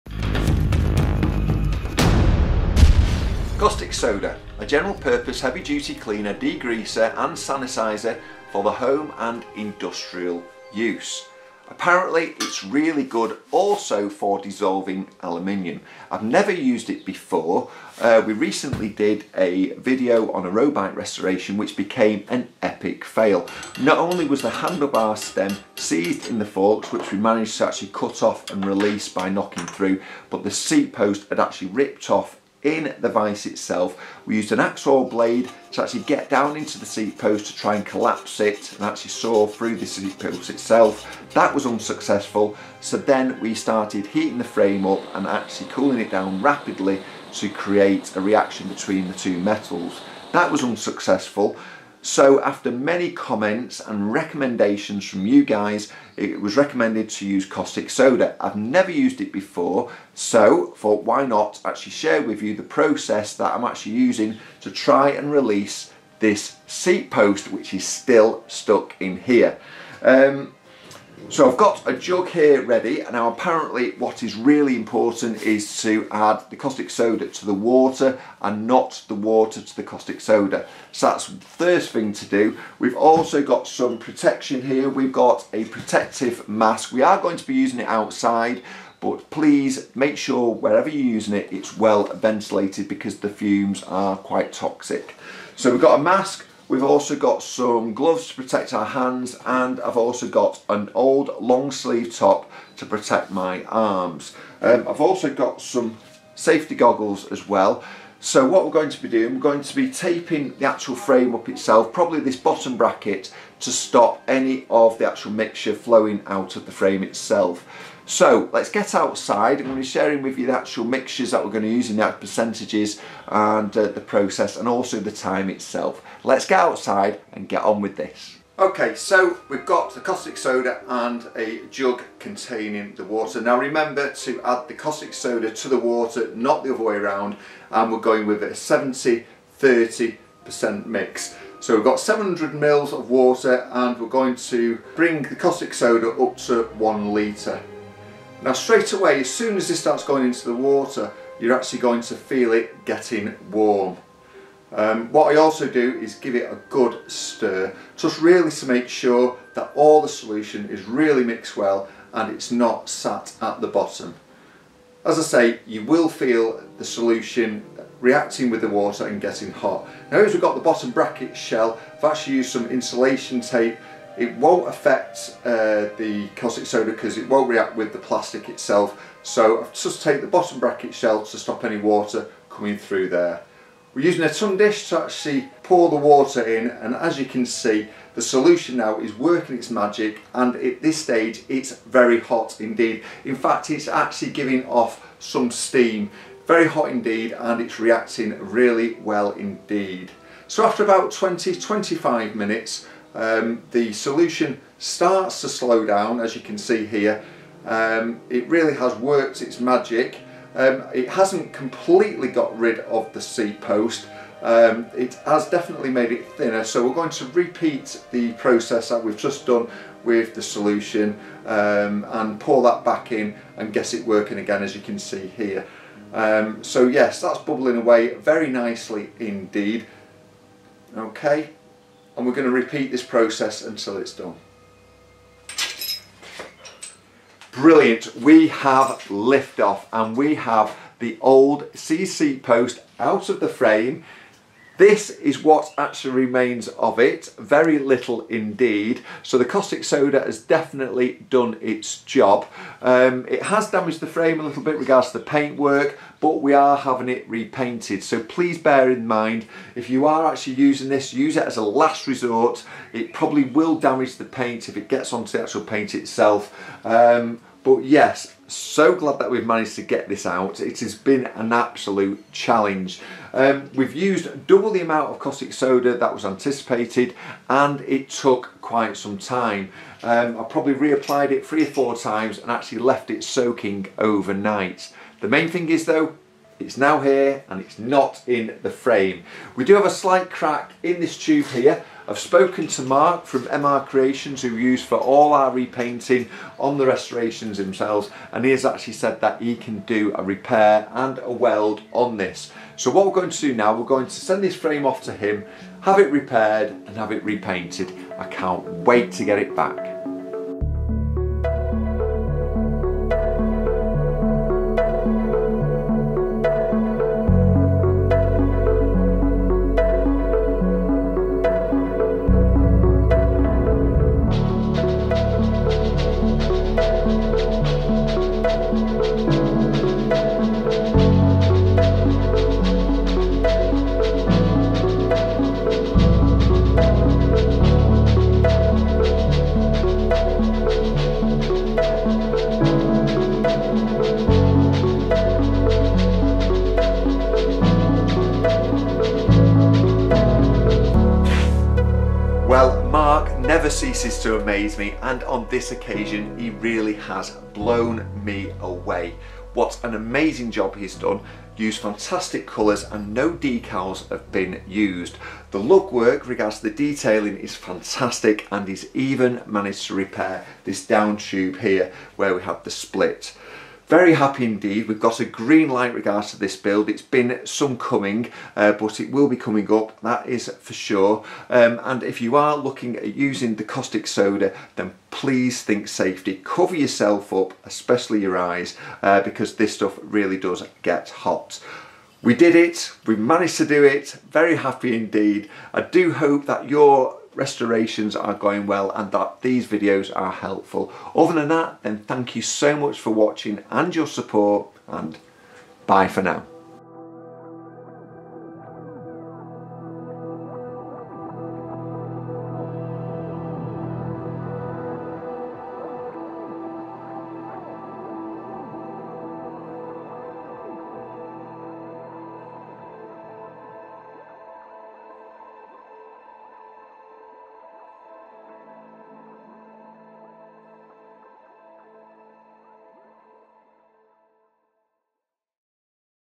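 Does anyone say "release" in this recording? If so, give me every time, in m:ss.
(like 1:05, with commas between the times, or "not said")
0:28, 1:05.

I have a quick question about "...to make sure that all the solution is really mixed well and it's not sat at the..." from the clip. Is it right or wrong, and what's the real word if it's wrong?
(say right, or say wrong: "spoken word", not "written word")
right.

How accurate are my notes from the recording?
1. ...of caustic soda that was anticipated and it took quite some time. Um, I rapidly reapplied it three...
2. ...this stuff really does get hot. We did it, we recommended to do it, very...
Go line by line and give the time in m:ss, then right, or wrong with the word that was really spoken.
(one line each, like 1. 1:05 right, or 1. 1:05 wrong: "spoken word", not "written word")
1. 4:35 wrong: "probably", not "rapidly"
2. 6:29 wrong: "managed", not "recommended".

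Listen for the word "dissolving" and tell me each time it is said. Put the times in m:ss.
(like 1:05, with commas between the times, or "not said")
0:14.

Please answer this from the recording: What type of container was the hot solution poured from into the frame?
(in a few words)
Tin dish.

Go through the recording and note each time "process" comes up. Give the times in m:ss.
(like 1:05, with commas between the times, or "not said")
1:02, 2:04, 3:38, 3:53.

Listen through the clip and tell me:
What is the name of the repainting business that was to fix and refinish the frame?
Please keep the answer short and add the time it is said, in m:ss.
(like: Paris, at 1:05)
MR Creations, at 4:53.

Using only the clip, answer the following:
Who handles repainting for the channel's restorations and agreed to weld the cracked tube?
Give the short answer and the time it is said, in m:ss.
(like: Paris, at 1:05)
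Mark, at 4:52.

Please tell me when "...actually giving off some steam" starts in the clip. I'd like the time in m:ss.
3:13.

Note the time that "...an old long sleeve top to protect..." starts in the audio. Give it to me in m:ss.
1:40.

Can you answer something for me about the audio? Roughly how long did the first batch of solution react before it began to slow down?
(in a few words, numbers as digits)
20-25 minutes.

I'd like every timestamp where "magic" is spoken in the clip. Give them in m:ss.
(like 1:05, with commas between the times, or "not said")
3:09, 3:29.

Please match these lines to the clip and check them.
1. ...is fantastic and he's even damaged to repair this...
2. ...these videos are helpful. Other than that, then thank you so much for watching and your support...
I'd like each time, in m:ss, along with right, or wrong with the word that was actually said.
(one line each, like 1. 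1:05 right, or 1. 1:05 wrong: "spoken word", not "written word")
1. 6:07 wrong: "managed", not "damaged"
2. 6:39 right.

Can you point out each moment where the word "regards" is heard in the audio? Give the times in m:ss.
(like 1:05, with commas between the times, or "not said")
4:14, 6:06, 6:15.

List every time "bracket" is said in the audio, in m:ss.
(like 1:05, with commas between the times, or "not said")
1:52, 2:50, 3:00.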